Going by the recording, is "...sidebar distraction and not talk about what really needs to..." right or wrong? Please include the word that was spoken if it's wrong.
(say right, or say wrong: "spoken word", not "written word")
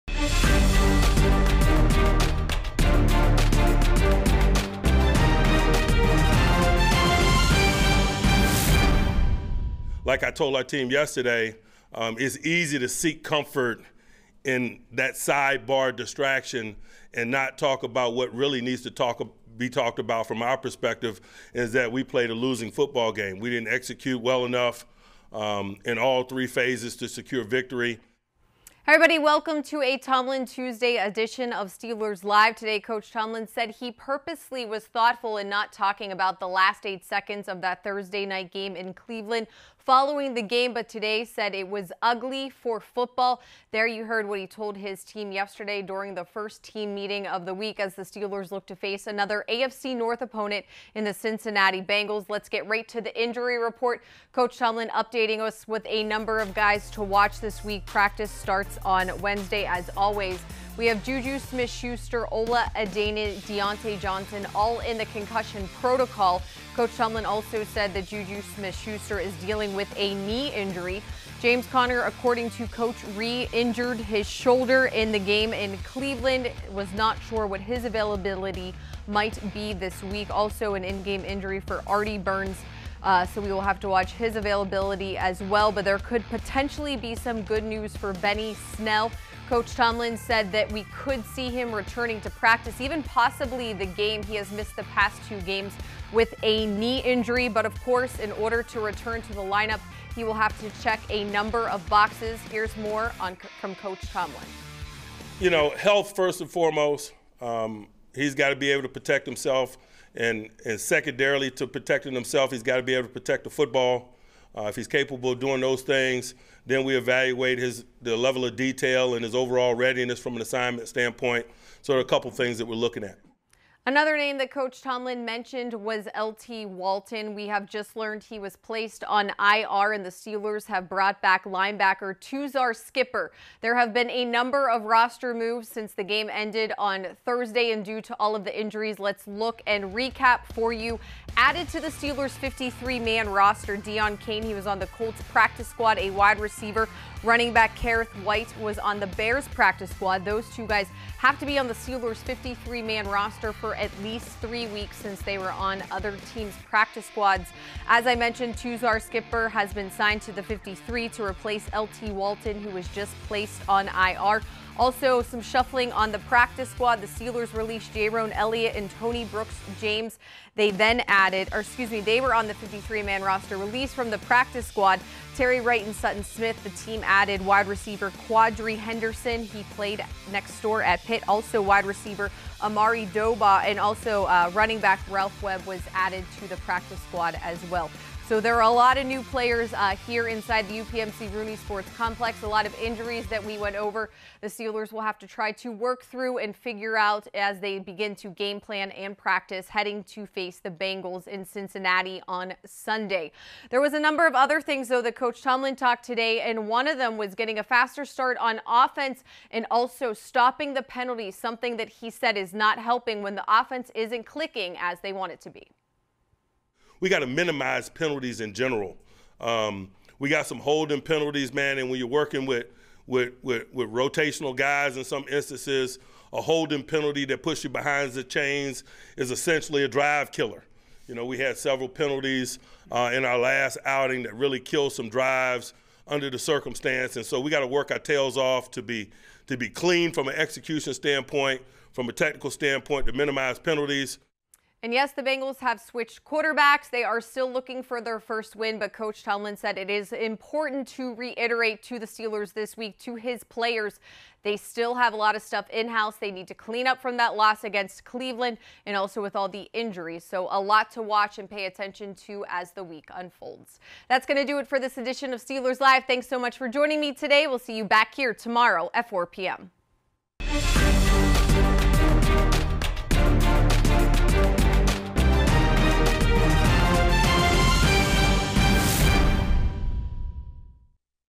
right.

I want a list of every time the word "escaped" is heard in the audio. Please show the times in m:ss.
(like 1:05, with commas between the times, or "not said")
not said.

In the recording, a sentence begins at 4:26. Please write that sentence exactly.
Thanks so much for joining me today.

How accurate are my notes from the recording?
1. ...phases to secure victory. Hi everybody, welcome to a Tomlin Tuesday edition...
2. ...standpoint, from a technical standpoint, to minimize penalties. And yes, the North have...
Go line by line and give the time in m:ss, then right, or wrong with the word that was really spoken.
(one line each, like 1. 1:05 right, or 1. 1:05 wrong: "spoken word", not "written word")
1. 0:26 right
2. 4:00 wrong: "Bengals", not "North".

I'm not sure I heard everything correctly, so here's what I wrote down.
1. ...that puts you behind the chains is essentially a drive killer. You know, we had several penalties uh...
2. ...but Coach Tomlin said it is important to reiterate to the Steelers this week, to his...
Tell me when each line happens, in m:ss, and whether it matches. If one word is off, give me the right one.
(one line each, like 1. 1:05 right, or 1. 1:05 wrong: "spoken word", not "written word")
1. 3:47 right
2. 4:08 right.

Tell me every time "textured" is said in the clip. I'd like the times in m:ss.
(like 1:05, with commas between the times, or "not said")
not said.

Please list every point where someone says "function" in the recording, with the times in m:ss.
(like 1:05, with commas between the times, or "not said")
not said.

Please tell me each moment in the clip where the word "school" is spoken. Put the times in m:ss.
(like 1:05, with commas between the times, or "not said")
not said.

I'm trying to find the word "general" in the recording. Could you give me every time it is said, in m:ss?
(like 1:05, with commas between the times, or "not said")
3:38.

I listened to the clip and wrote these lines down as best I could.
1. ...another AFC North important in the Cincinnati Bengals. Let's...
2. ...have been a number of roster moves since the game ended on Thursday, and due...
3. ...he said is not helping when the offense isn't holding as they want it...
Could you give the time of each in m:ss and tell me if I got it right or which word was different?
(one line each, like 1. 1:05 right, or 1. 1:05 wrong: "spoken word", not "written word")
1. 0:49 wrong: "opponent", not "important"
2. 2:13 right
3. 3:31 wrong: "clicking", not "holding".